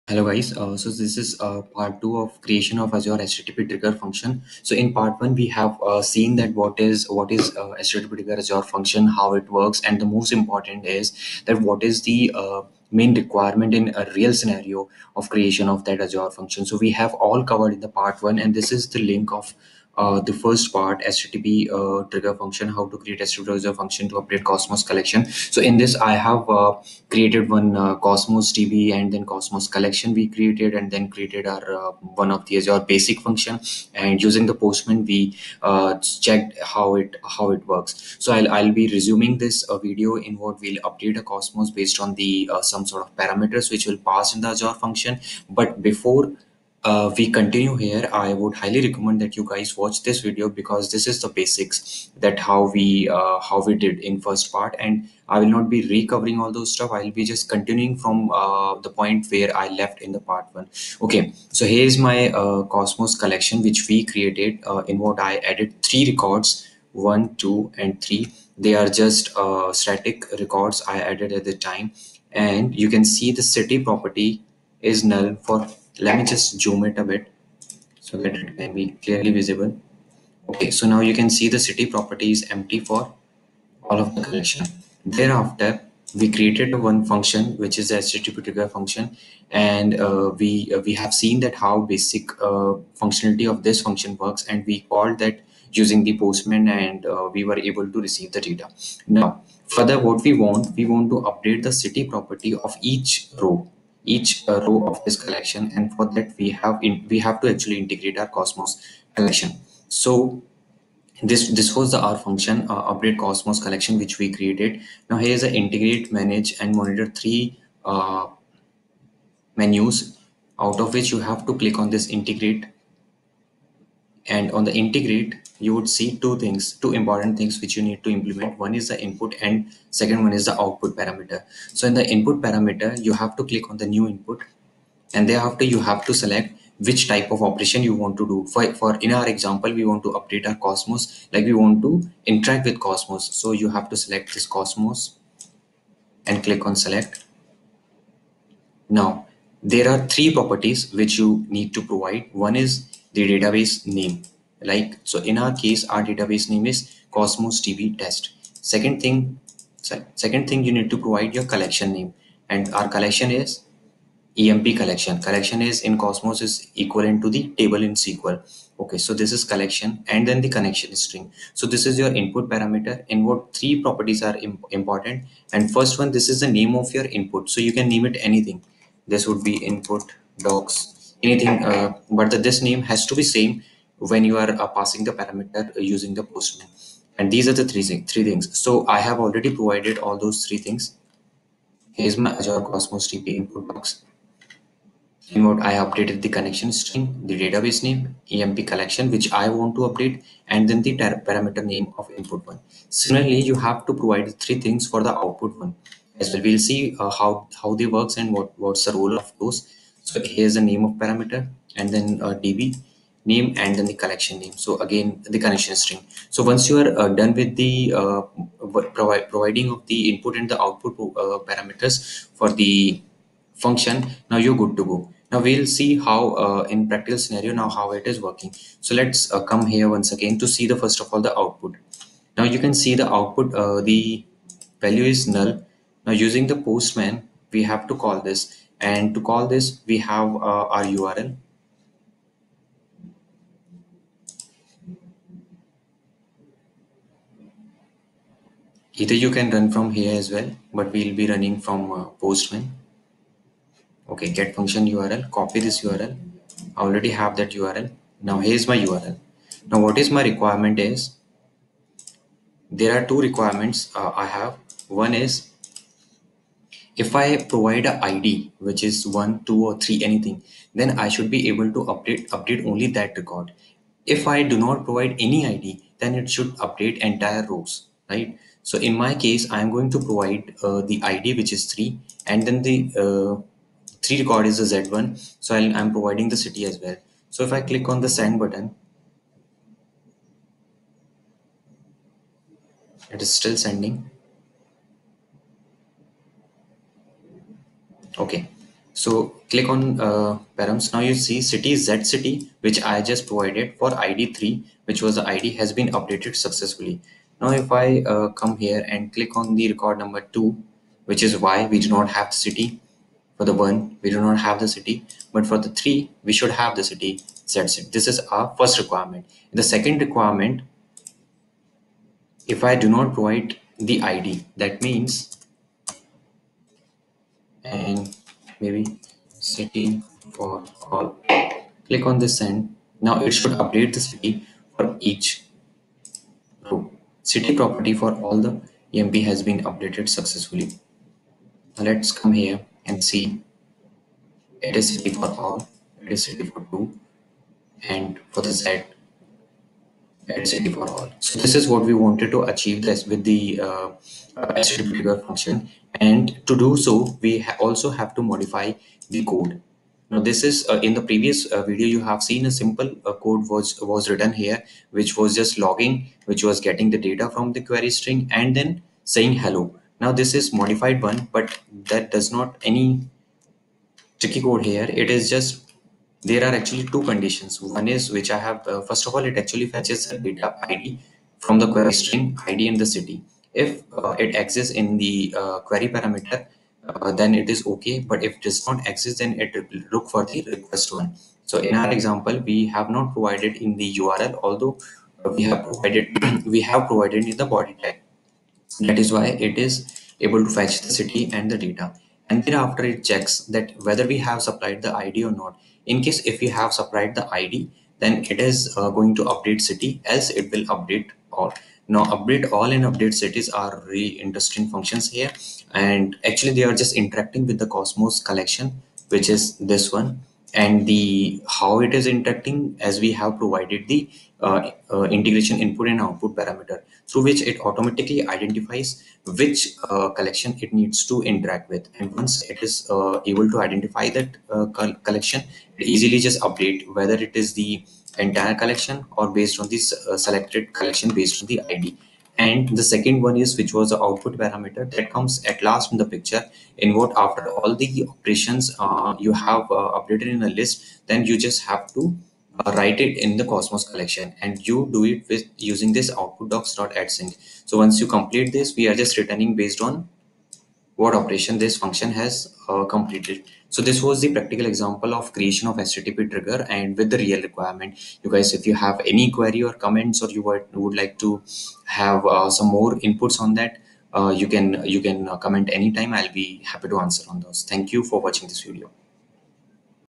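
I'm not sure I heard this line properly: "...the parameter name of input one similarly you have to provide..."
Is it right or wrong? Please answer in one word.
right.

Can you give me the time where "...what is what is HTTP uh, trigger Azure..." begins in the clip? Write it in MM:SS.
00:06.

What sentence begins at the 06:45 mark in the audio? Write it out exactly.
In case if we have supplied the ID, then it is uh, going to update city, else it will update all.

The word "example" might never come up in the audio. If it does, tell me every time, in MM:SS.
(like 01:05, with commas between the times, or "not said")
02:19, 06:31, 07:44.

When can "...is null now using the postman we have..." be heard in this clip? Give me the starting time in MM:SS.
03:55.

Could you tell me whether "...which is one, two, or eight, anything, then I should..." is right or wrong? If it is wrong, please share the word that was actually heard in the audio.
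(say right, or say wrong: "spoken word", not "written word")
wrong: "three", not "eight".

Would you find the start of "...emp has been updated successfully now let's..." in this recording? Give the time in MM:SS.
05:38.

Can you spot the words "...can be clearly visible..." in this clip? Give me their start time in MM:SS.
01:18.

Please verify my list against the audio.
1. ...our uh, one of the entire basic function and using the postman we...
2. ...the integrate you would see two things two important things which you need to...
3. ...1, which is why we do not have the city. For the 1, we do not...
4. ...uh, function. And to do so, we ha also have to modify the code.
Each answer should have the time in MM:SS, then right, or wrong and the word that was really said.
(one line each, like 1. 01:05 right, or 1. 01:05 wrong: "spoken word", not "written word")
1. 00:31 wrong: "azure", not "entire"
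2. 02:04 right
3. 05:10 wrong: "2", not "1"
4. 05:55 right.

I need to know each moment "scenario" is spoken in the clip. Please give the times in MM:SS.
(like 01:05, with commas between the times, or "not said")
00:14, 03:47.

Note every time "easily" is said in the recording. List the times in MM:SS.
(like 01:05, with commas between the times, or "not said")
07:15.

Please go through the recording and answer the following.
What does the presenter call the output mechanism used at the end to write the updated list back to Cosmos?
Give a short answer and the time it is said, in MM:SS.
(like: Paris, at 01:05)
output sync, at 07:36.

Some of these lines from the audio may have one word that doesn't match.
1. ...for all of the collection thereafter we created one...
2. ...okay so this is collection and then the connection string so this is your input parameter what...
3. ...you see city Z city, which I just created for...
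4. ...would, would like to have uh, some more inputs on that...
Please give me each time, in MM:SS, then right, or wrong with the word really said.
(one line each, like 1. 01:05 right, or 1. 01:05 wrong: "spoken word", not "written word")
1. 01:22 right
2. 02:48 right
3. 05:00 wrong: "provided", not "created"
4. 07:50 right.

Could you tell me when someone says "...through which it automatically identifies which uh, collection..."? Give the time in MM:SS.
07:07.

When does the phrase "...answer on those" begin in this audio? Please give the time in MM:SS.
07:57.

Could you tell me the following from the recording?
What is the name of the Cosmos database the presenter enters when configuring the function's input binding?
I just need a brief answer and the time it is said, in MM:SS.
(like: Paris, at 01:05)
cosmos db test, at 02:37.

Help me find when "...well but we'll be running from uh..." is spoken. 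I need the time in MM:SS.
04:10.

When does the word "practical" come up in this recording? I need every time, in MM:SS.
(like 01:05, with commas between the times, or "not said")
03:46, 07:44.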